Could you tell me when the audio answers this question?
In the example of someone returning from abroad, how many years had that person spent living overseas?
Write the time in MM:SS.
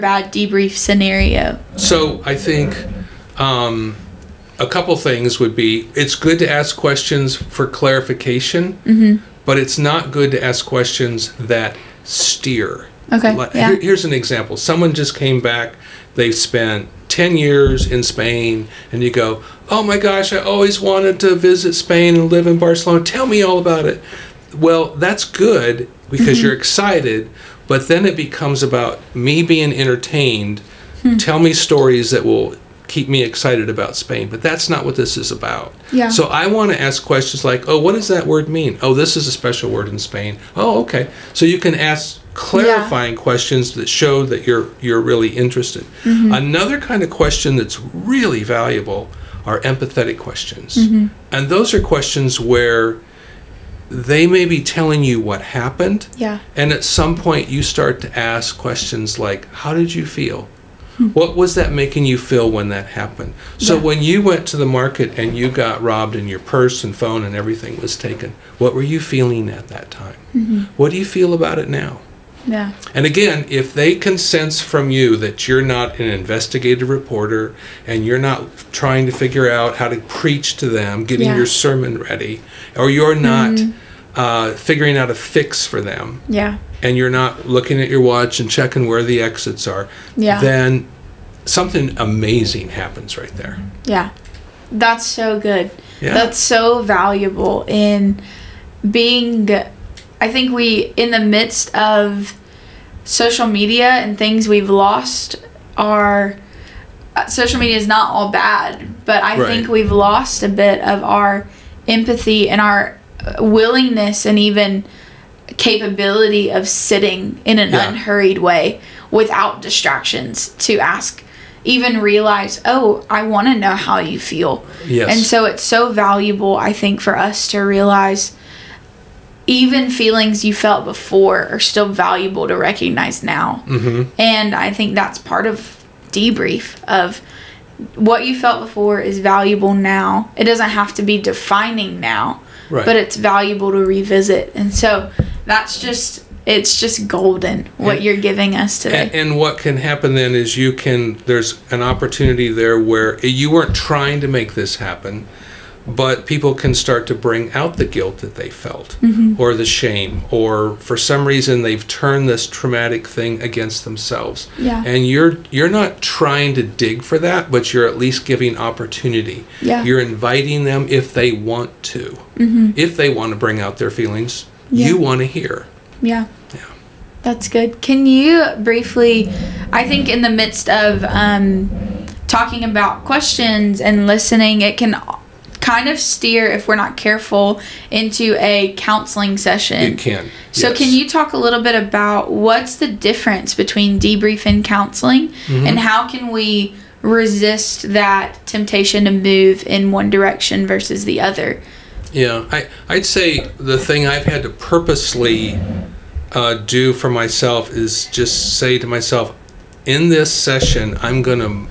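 00:17.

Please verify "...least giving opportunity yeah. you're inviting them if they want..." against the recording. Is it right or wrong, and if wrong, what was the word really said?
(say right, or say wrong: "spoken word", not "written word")
right.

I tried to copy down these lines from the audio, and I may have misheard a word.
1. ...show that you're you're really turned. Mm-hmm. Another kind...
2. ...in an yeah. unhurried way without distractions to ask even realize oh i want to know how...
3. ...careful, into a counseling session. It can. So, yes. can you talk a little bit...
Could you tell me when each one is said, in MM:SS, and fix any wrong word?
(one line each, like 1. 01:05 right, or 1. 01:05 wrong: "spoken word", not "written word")
1. 00:43 wrong: "interested", not "turned"
2. 01:57 right
3. 03:06 right.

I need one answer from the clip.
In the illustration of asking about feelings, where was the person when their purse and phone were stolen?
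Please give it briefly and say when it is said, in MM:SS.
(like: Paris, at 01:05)
the market, at 01:04.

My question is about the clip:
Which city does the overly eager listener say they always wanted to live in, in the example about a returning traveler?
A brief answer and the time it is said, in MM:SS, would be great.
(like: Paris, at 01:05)
Barcelona, at 00:22.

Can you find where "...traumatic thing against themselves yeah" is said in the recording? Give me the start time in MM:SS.
02:42.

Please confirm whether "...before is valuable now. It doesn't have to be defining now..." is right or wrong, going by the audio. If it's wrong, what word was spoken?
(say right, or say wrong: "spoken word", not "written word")
right.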